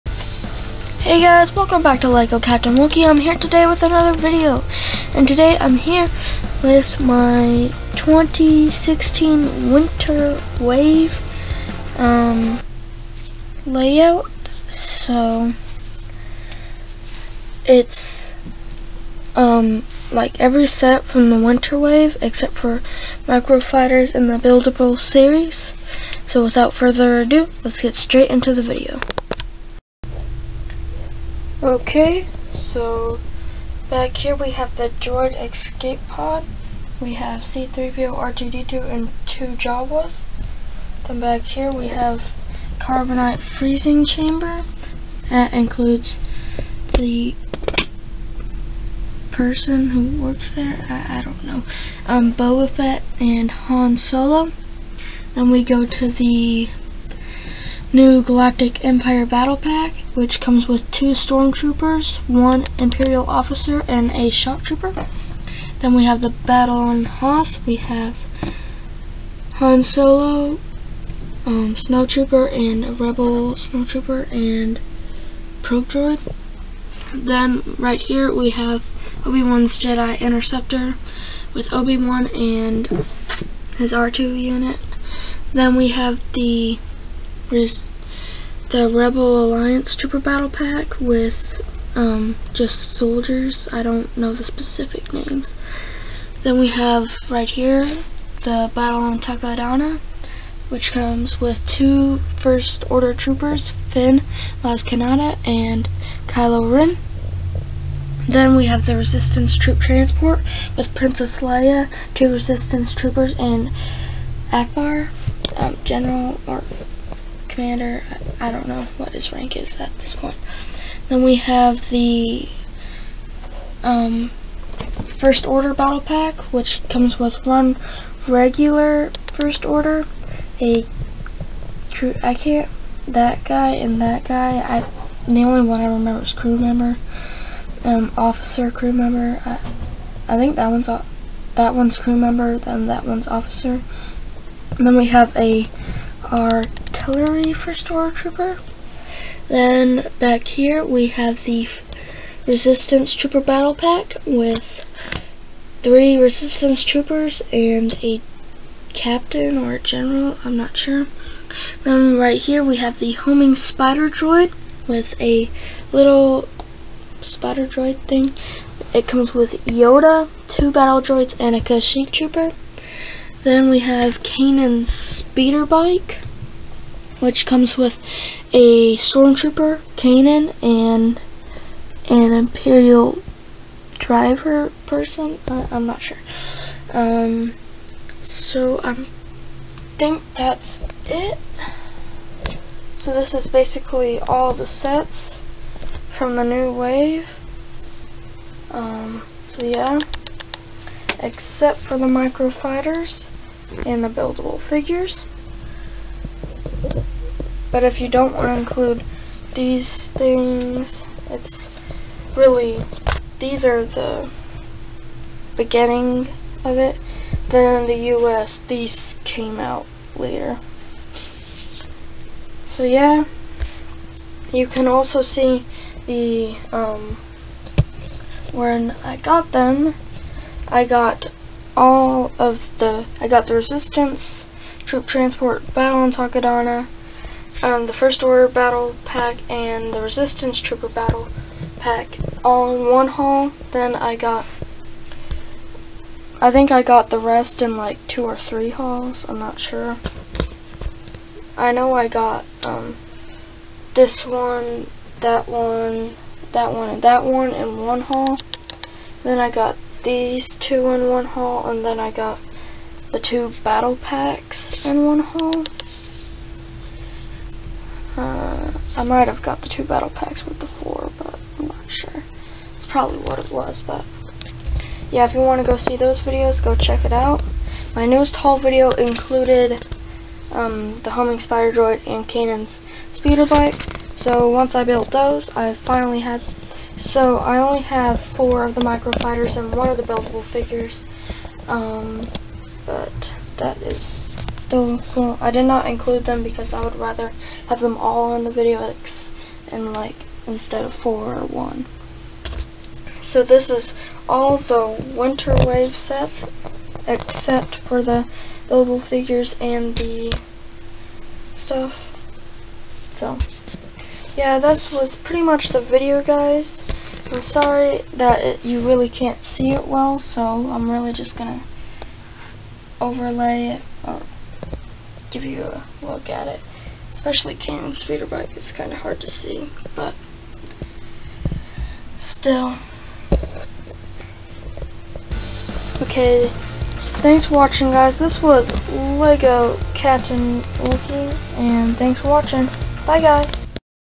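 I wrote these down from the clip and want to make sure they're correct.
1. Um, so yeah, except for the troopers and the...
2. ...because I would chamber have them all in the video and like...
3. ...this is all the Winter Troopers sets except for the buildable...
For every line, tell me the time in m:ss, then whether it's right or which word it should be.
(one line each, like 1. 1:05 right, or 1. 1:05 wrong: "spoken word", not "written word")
1. 3:18 wrong: "microfighters", not "troopers"
2. 4:56 wrong: "rather", not "chamber"
3. 5:03 wrong: "Wave", not "Troopers".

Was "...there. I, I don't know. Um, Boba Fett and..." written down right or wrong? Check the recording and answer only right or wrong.
right.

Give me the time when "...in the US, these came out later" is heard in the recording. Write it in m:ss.
3:37.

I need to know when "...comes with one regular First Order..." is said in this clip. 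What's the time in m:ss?
2:06.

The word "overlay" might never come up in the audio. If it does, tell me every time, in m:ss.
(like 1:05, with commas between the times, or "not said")
5:23.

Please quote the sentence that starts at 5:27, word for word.
Especially Kanan's speeder bike, it's kind of hard to see, but still.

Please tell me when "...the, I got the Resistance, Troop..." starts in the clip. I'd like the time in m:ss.
3:52.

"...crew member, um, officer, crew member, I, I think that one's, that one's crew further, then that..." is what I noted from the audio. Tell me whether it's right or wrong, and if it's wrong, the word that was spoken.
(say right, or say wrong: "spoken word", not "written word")
wrong: "member", not "further".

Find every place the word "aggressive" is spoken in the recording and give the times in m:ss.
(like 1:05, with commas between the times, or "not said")
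not said.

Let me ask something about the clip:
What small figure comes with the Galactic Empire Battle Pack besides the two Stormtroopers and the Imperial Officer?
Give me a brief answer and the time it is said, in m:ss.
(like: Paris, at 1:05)
Shock Trooper, at 1:04.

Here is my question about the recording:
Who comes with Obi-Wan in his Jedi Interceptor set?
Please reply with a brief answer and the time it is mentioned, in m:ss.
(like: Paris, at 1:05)
His R2 unit, at 1:23.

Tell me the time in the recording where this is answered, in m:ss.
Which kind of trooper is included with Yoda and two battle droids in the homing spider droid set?
2:51.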